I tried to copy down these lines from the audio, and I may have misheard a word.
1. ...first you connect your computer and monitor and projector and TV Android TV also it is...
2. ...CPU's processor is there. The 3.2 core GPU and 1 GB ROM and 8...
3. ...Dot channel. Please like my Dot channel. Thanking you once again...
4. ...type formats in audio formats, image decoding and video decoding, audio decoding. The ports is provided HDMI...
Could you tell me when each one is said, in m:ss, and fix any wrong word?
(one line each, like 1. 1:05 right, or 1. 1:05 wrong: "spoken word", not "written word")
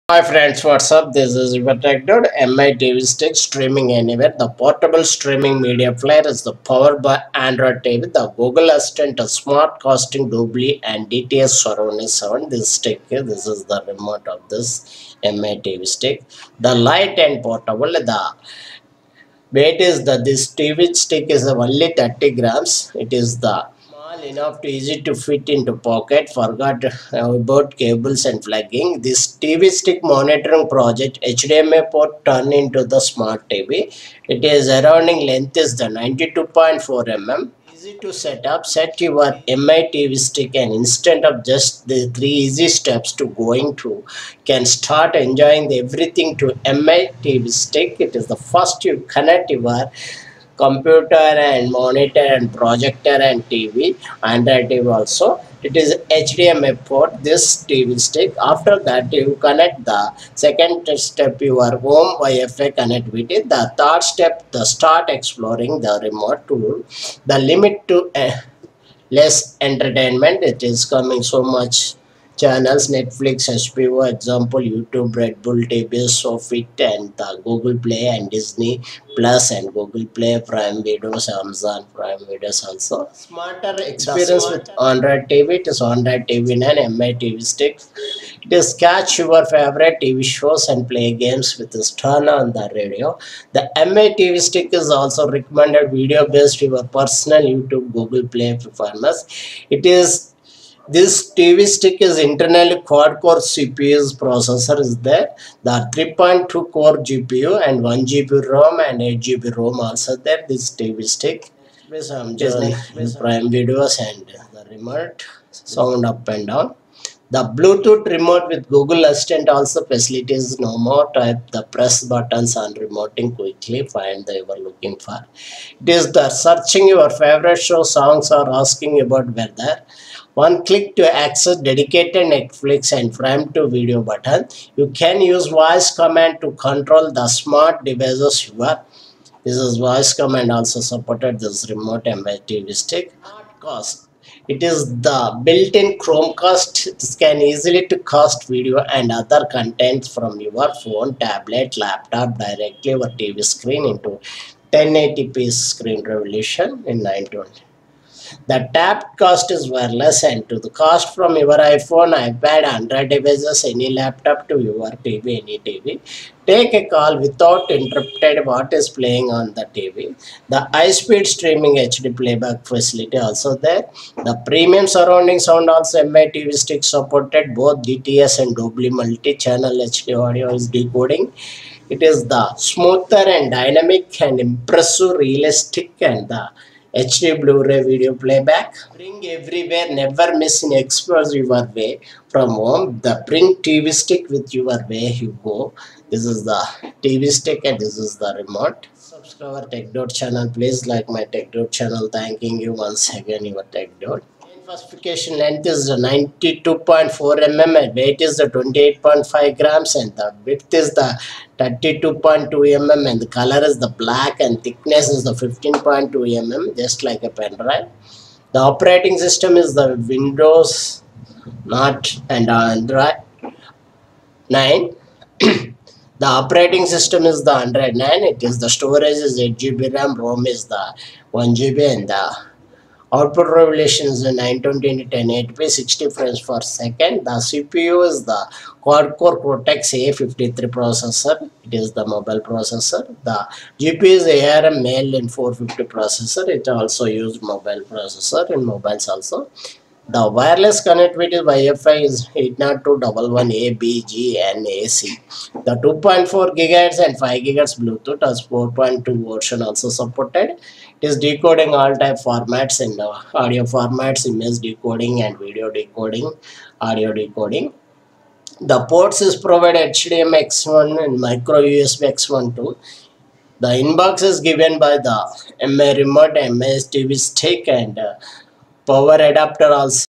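1. 0:48 right
2. 1:43 right
3. 3:19 right
4. 4:21 right.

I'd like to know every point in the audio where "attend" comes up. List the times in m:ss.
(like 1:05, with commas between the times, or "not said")
not said.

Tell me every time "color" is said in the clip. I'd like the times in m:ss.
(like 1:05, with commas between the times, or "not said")
3:33.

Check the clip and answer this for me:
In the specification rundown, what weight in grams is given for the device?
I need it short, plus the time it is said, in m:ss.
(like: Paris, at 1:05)
28.5 grams, at 3:28.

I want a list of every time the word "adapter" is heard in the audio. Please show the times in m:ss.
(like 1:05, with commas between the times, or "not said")
4:39.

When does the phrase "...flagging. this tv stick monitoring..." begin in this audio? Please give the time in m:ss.
0:28.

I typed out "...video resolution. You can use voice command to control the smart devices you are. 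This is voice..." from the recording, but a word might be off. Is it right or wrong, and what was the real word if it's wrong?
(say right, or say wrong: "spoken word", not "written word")
wrong: "button", not "resolution".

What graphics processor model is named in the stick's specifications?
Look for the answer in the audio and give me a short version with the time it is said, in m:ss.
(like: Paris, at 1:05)
ARM Mali 450, at 4:04.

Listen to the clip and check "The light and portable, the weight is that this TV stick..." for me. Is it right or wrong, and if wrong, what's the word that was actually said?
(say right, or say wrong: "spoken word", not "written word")
right.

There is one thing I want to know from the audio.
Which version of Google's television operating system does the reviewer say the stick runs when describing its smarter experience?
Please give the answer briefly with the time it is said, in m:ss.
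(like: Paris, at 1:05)
Android TV 9, at 1:25.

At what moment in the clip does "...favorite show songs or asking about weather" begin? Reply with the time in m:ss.
2:07.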